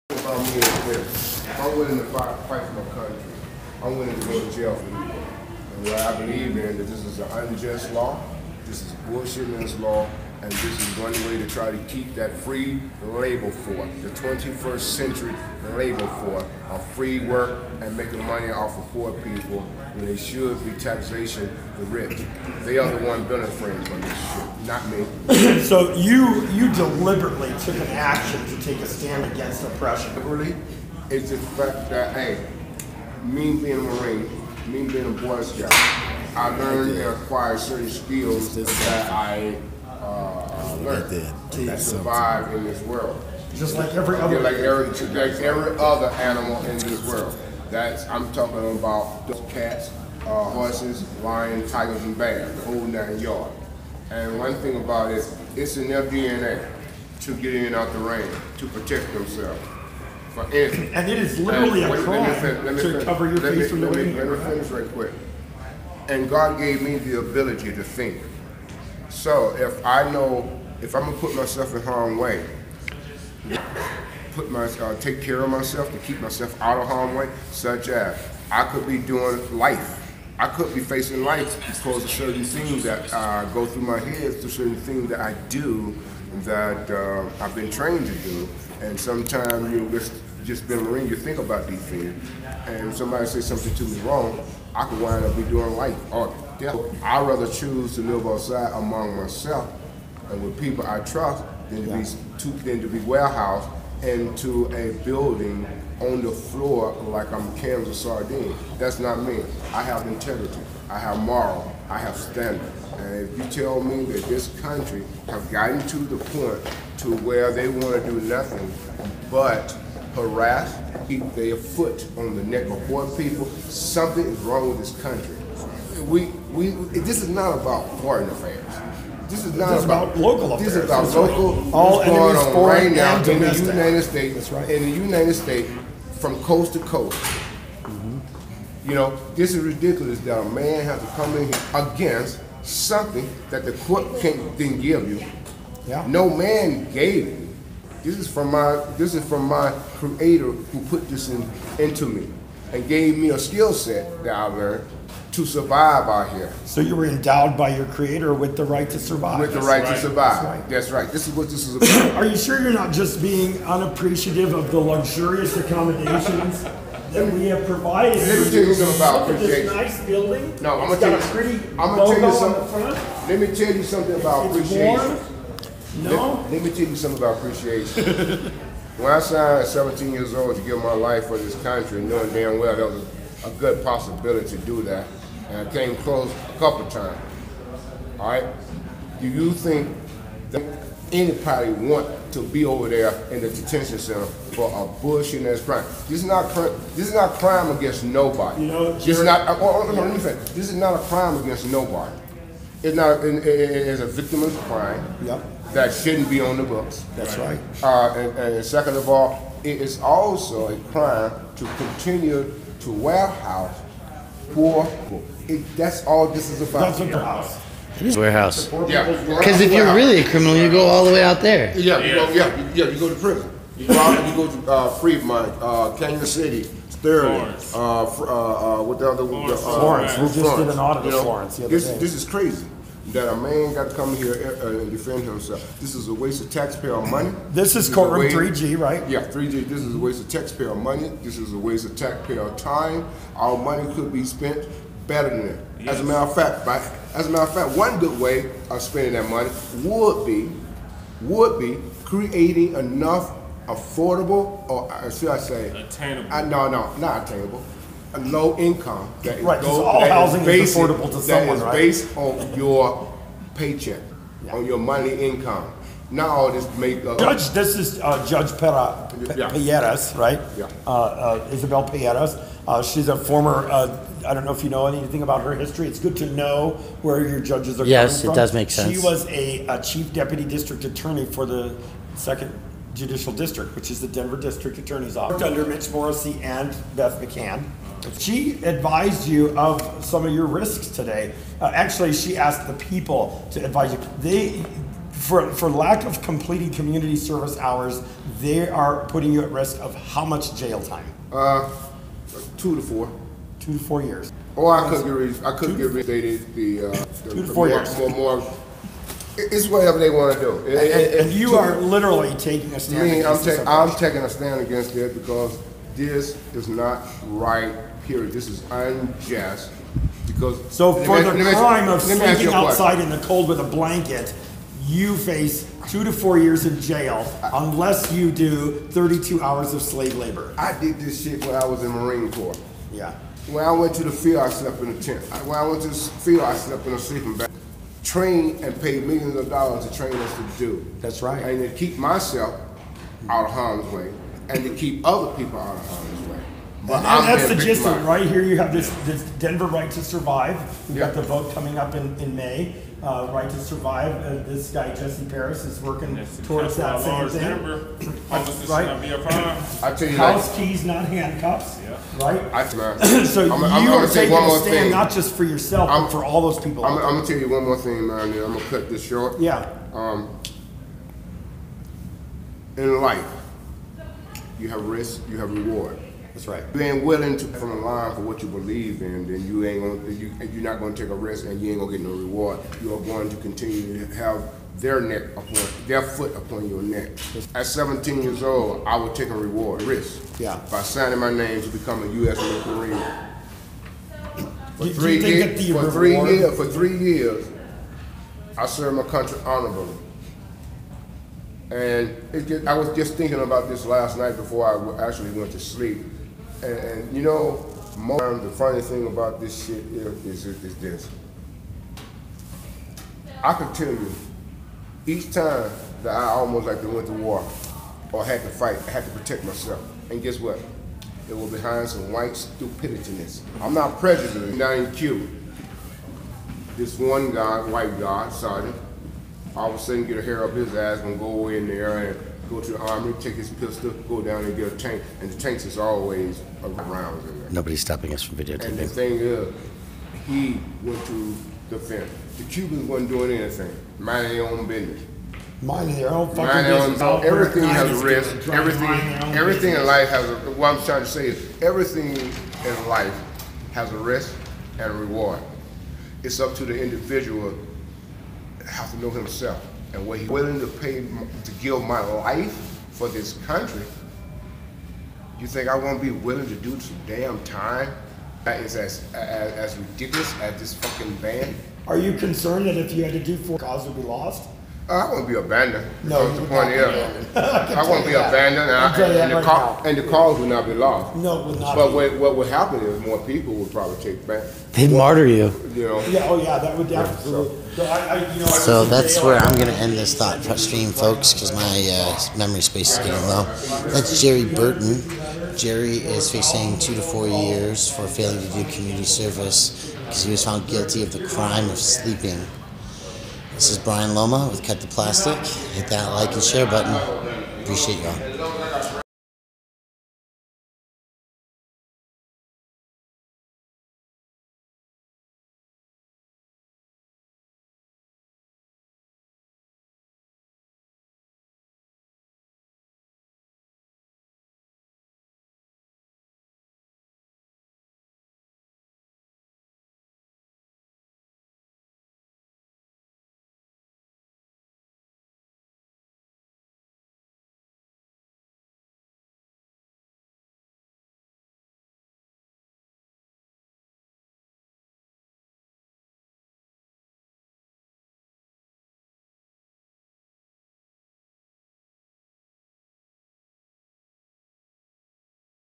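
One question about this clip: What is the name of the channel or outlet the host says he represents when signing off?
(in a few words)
Cut the Plastic.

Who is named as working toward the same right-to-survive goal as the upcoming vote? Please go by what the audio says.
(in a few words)
Jesse Parris.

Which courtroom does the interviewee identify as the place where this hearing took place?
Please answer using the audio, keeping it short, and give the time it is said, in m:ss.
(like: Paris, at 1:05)
3G, at 3:57.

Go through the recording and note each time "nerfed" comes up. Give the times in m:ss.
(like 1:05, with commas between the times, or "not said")
not said.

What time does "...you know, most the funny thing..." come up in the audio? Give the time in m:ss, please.
6:47.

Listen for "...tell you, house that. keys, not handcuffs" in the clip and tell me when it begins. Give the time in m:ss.
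5:59.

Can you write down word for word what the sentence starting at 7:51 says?
Are you concerned that if you had to do four, cause would be lost?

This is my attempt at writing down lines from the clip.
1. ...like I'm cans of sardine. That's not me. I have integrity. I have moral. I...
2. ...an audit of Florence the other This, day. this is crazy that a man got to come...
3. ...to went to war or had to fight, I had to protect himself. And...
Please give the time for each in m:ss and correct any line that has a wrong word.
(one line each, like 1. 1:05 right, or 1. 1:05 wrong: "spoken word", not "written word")
1. 1:47 right
2. 3:50 right
3. 6:56 wrong: "myself", not "himself".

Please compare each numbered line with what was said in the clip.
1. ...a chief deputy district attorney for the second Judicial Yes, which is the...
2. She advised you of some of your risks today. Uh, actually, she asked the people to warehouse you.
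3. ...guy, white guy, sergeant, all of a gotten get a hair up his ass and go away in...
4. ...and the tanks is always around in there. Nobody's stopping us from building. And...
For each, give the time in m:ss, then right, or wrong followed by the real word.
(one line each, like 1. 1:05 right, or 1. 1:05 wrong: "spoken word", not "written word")
1. 4:39 wrong: "District", not "Yes"
2. 4:48 wrong: "advise", not "warehouse"
3. 7:07 wrong: "sudden", not "gotten"
4. 7:15 wrong: "videotaping", not "building".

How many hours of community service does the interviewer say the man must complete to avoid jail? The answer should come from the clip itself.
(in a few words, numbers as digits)
32.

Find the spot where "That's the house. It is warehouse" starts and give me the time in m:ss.
3:36.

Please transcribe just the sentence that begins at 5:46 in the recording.
But and that's the gist of it, right here.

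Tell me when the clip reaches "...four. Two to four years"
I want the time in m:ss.
5:02.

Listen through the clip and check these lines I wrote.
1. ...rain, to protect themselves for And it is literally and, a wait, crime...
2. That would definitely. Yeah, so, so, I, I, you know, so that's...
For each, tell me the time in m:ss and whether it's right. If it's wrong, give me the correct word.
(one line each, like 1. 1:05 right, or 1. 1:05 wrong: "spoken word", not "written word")
1. 0:57 right
2. 8:06 right.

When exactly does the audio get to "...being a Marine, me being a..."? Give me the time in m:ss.
0:33.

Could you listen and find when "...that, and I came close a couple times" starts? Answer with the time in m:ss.
3:04.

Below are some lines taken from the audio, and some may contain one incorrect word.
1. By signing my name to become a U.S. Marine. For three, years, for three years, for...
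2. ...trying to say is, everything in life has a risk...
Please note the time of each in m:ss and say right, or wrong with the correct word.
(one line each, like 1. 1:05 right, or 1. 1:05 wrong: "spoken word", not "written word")
1. 6:30 right
2. 7:30 right.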